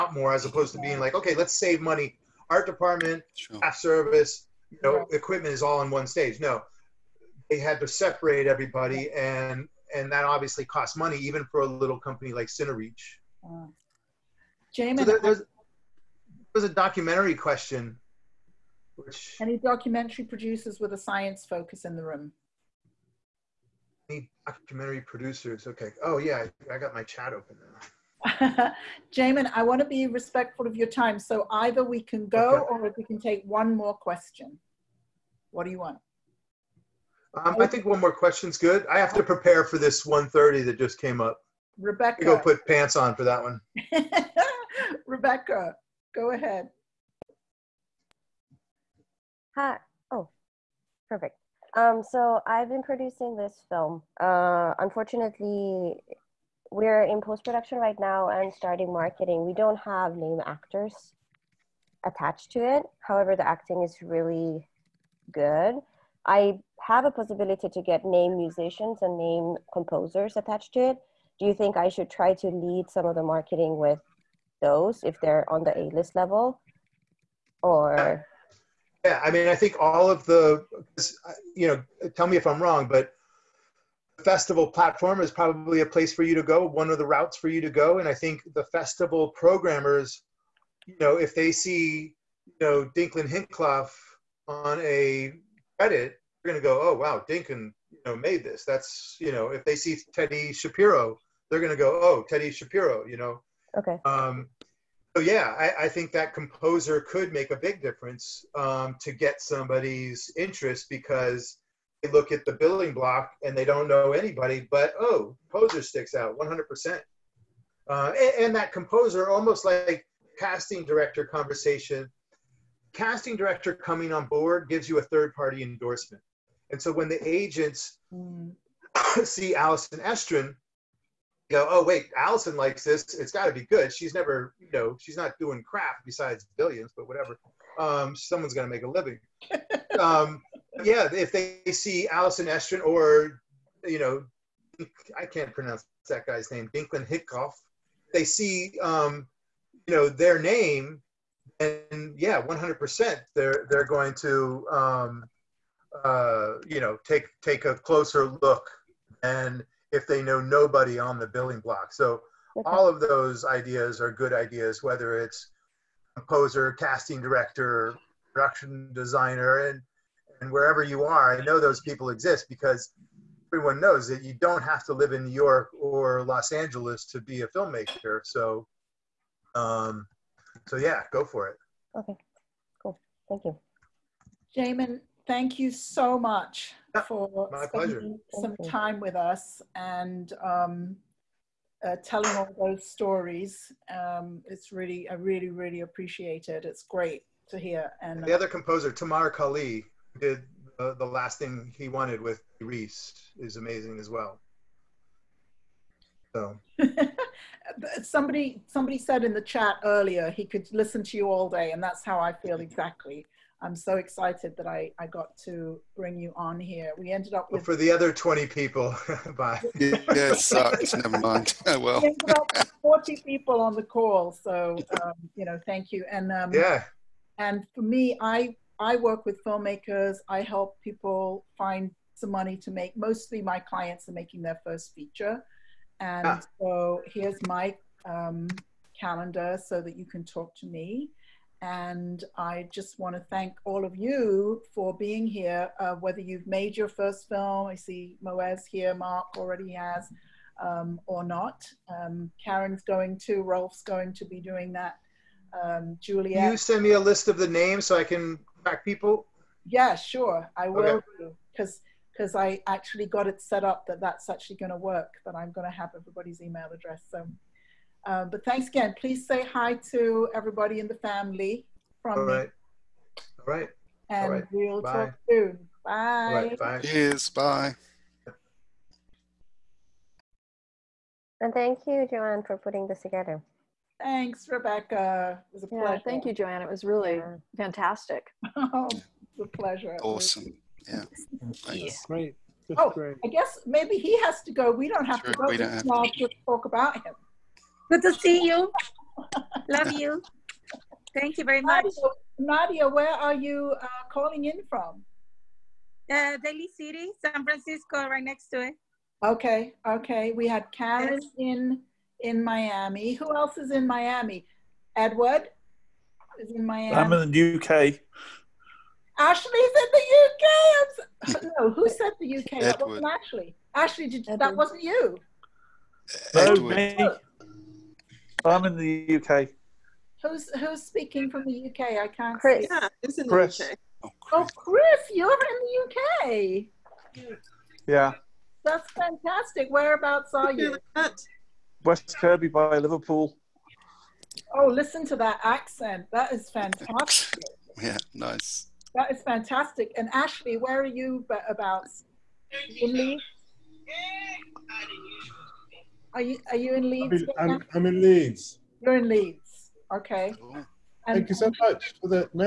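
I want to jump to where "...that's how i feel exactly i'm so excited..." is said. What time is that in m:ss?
3:31.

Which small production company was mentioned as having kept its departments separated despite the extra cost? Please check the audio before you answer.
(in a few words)
Cinereach.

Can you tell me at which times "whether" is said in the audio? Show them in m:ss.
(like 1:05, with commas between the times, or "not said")
2:44, 4:05.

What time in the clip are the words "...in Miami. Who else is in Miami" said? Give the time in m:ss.
5:12.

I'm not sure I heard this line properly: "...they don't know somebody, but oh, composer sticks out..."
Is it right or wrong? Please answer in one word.
wrong.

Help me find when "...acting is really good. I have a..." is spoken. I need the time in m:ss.
1:03.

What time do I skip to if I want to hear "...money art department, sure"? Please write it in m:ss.
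0:01.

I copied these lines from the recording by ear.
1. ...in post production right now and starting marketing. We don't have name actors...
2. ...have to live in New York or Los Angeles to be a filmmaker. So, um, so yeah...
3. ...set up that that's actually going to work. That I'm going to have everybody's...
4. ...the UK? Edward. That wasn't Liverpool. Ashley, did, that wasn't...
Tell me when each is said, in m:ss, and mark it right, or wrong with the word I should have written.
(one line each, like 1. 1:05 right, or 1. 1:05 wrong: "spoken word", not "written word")
1. 0:57 right
2. 2:54 right
3. 4:23 right
4. 5:22 wrong: "Ashley", not "Liverpool".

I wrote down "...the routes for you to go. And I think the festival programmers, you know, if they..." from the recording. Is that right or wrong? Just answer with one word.
right.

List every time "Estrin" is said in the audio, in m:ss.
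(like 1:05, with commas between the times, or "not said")
2:09, 2:22.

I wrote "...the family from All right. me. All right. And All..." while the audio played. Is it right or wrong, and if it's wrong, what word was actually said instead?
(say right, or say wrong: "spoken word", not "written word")
right.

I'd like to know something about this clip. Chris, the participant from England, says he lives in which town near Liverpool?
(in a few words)
West Kirby.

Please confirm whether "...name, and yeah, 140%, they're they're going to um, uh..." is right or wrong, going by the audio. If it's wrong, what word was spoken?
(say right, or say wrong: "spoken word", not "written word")
wrong: "100", not "140".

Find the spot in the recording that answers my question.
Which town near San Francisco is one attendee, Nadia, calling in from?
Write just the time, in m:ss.
5:06.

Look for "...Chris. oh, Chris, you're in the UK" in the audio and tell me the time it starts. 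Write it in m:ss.
5:34.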